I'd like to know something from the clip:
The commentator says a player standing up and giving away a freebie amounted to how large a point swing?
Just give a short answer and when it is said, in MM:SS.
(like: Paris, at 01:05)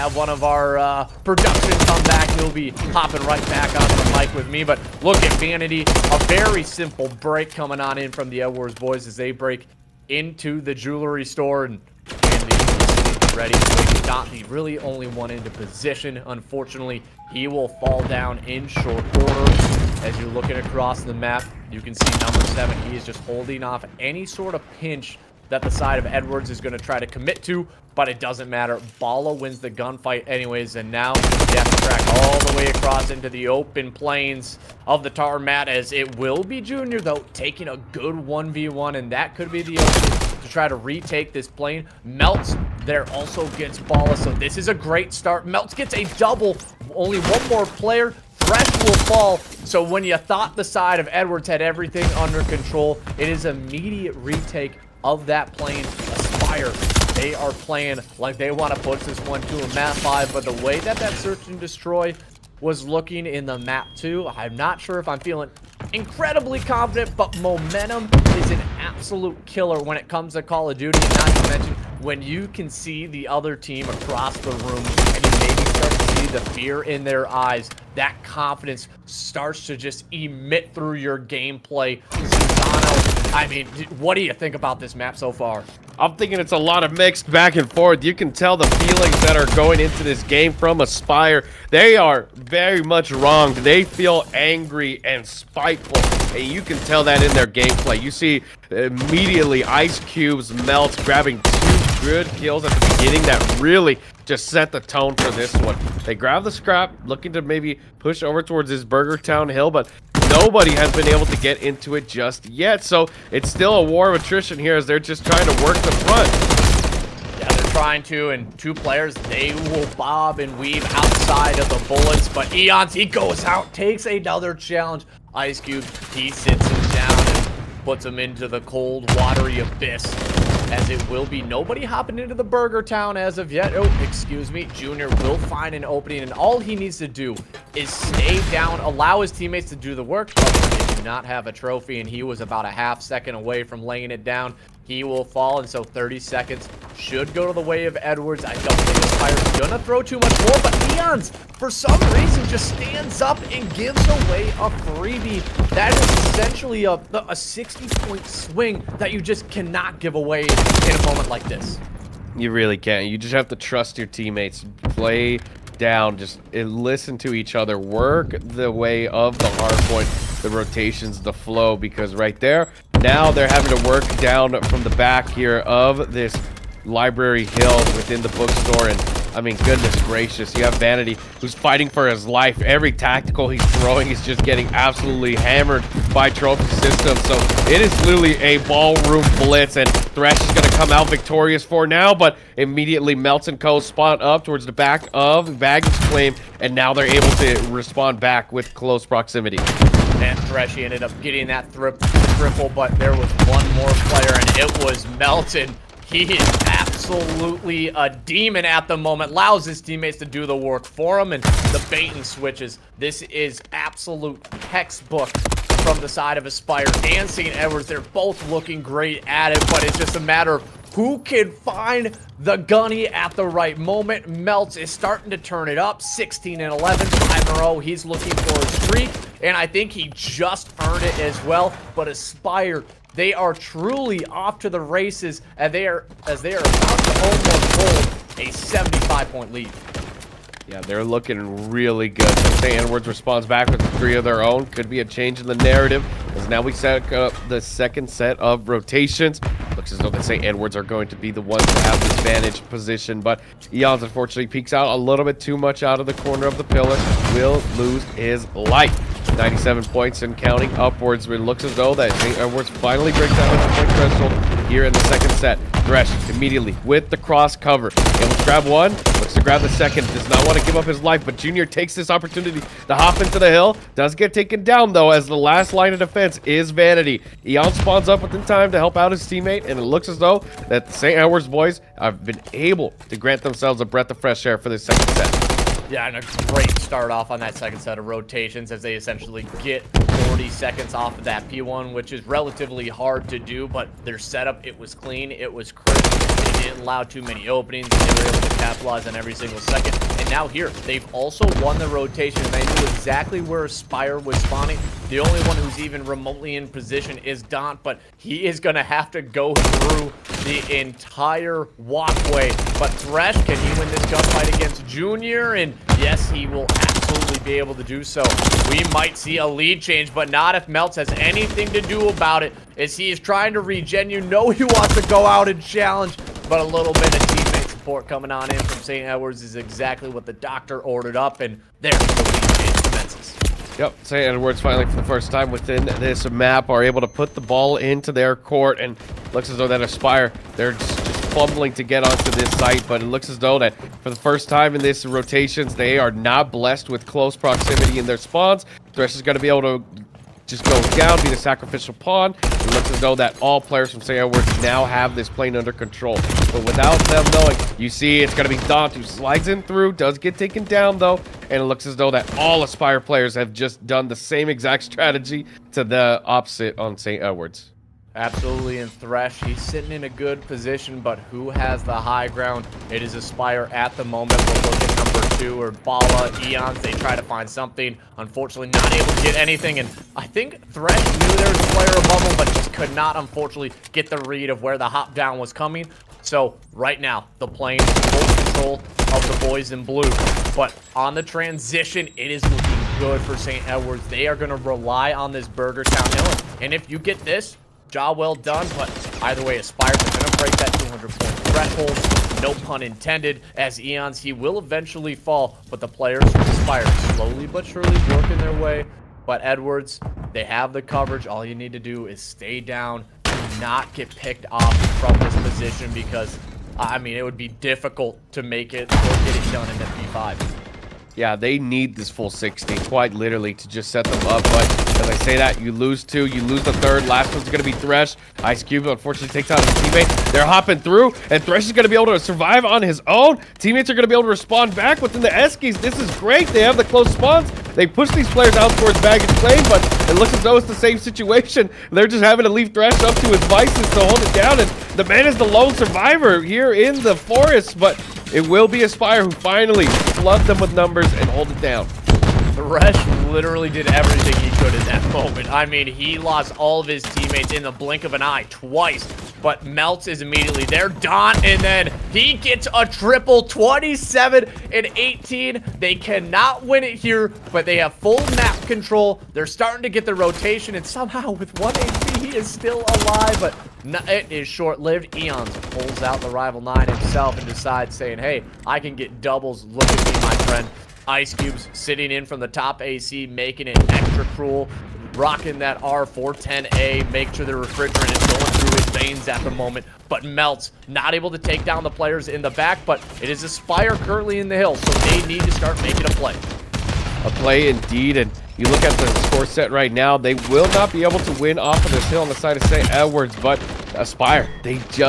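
60, at 02:36.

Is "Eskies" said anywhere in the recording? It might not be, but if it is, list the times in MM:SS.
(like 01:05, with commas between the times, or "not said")
07:15.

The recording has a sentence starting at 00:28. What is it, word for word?
Bala wins the gunfight anyways, and now to Track all the way across into the open plains of the mat.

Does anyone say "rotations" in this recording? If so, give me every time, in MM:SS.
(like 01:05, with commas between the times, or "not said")
02:50, 04:08, 04:48, 05:01, 05:45, 07:50.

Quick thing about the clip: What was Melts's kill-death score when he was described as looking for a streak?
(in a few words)
16 and 11.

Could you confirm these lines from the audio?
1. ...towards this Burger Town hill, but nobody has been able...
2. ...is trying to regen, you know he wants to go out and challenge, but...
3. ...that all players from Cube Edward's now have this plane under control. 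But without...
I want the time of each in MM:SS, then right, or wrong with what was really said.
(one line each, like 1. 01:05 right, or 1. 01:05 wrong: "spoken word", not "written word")
1. 01:48 right
2. 05:23 right
3. 05:53 wrong: "Saint", not "Cube".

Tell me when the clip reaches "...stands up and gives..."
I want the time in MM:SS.
02:32.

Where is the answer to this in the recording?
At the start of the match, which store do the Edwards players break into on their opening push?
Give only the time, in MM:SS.
00:10.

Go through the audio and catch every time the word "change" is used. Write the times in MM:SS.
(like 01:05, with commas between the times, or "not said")
04:05, 05:19.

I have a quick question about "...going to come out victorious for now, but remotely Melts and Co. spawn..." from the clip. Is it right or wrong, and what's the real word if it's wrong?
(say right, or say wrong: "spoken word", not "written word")
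wrong: "immediately", not "remotely".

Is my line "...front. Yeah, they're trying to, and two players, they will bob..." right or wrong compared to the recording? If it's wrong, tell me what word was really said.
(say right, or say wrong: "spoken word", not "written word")
right.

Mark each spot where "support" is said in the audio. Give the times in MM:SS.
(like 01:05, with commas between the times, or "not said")
05:27.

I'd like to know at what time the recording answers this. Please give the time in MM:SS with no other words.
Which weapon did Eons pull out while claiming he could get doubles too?
07:56.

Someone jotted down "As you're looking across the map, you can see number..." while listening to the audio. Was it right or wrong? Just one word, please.
right.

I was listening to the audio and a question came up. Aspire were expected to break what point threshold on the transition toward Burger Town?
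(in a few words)
200.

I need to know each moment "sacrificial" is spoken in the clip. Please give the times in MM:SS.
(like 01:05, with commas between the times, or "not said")
05:51.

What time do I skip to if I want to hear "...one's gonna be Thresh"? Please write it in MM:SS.
07:07.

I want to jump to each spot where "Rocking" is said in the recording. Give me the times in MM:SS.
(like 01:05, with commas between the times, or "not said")
08:05.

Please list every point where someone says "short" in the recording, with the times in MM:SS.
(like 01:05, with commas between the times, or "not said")
00:18, 07:54.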